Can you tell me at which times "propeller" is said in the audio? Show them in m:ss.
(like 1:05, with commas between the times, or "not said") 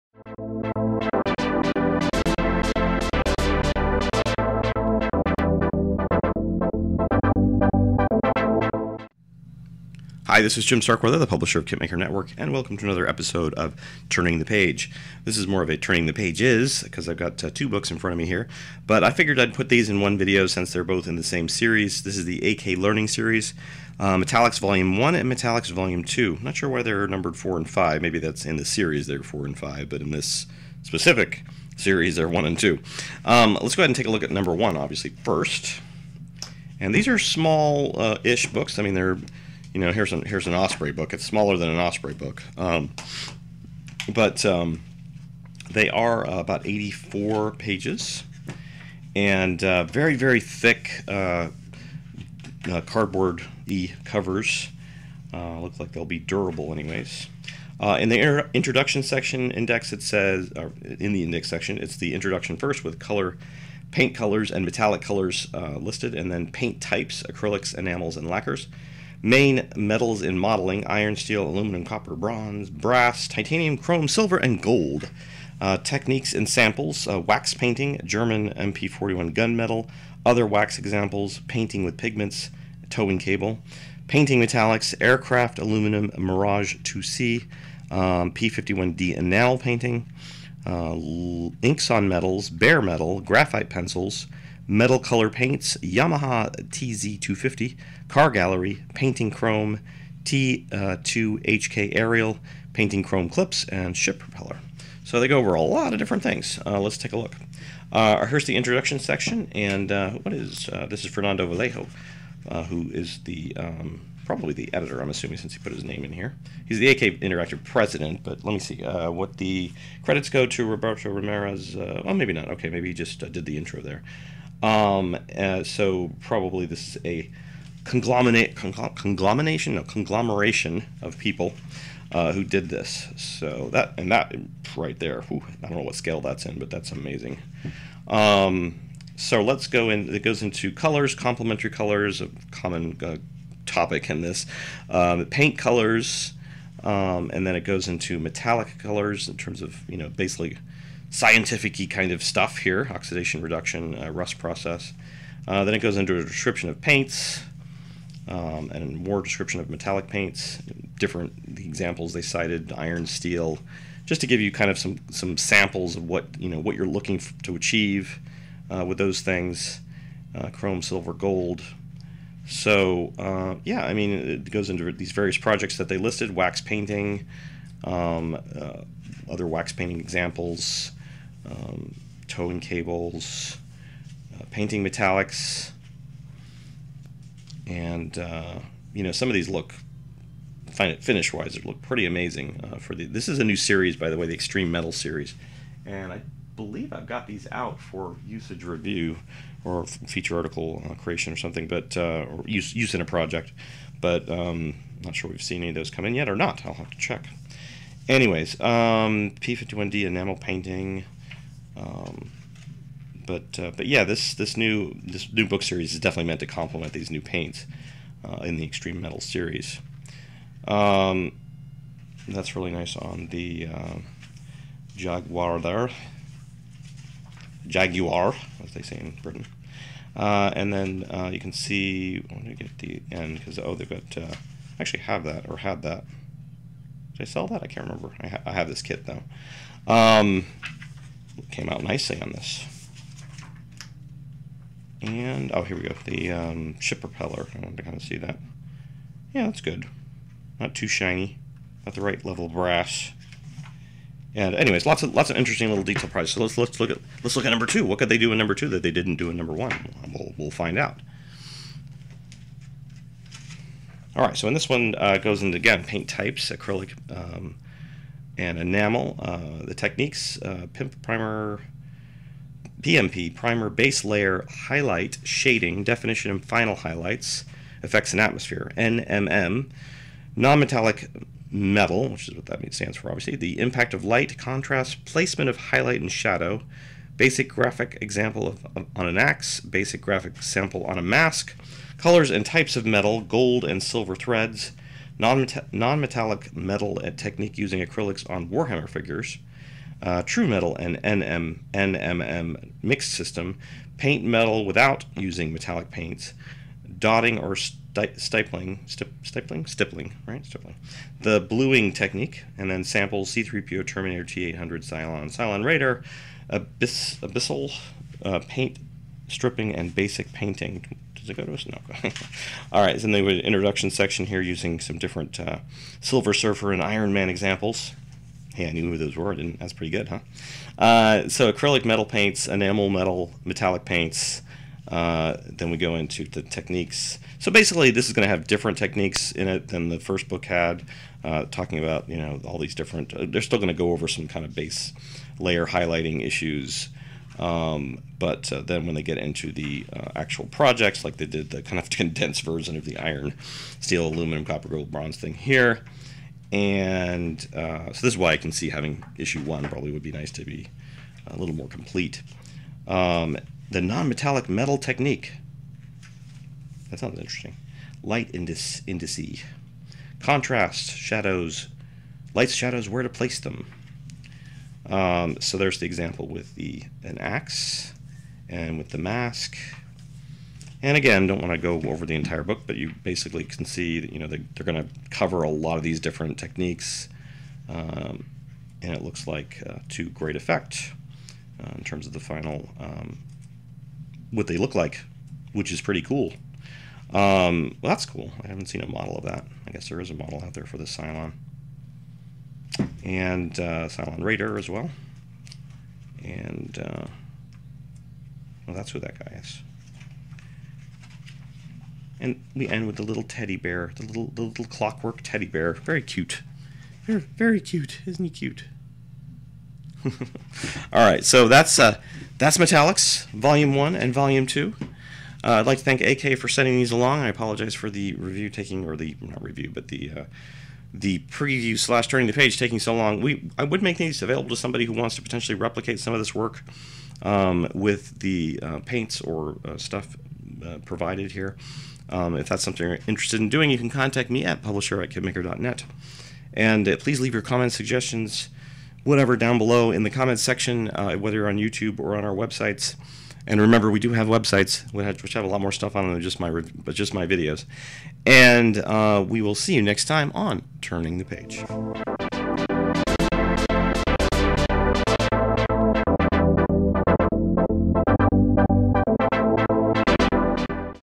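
1:44, 4:07.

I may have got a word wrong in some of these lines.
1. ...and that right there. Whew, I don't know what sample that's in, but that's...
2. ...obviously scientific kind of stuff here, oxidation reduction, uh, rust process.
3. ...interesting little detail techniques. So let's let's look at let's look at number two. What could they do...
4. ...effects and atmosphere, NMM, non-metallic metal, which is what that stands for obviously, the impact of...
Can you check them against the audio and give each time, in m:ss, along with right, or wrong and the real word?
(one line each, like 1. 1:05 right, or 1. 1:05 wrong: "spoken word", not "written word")
1. 2:13 wrong: "scale", not "sample"
2. 2:30 wrong: "basically", not "obviously"
3. 4:15 wrong: "prizes", not "techniques"
4. 4:37 right.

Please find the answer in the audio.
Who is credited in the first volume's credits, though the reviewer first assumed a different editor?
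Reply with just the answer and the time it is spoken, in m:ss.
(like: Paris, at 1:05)
Roberto Ramirez, at 2:00.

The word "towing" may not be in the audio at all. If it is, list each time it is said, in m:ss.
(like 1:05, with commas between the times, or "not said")
1:22, 3:02.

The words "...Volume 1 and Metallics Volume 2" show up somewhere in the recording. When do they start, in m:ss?
0:24.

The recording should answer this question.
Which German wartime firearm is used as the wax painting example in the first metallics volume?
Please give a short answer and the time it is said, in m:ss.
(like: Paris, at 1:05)
MP41, at 1:18.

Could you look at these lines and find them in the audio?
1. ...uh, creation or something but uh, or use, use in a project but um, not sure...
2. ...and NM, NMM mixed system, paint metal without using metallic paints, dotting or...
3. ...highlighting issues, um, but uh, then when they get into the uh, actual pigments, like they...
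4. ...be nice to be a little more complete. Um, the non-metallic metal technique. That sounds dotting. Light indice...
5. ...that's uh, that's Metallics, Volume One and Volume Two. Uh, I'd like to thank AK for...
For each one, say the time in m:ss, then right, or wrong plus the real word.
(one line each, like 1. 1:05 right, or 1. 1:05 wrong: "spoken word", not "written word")
1. 3:20 right
2. 5:00 right
3. 5:45 wrong: "projects", not "pigments"
4. 6:00 wrong: "interesting", not "dotting"
5. 7:01 right.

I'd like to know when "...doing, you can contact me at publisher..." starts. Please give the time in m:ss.
7:23.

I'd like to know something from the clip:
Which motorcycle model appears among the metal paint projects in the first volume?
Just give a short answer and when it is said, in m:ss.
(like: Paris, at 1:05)
Yamaha TZ250, at 1:35.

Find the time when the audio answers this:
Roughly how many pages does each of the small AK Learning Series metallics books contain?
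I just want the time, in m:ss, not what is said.
0:46.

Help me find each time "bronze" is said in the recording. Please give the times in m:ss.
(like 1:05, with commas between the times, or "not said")
1:12, 5:54.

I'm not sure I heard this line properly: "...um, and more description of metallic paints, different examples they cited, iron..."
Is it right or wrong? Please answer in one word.
right.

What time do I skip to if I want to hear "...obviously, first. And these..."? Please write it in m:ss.
0:34.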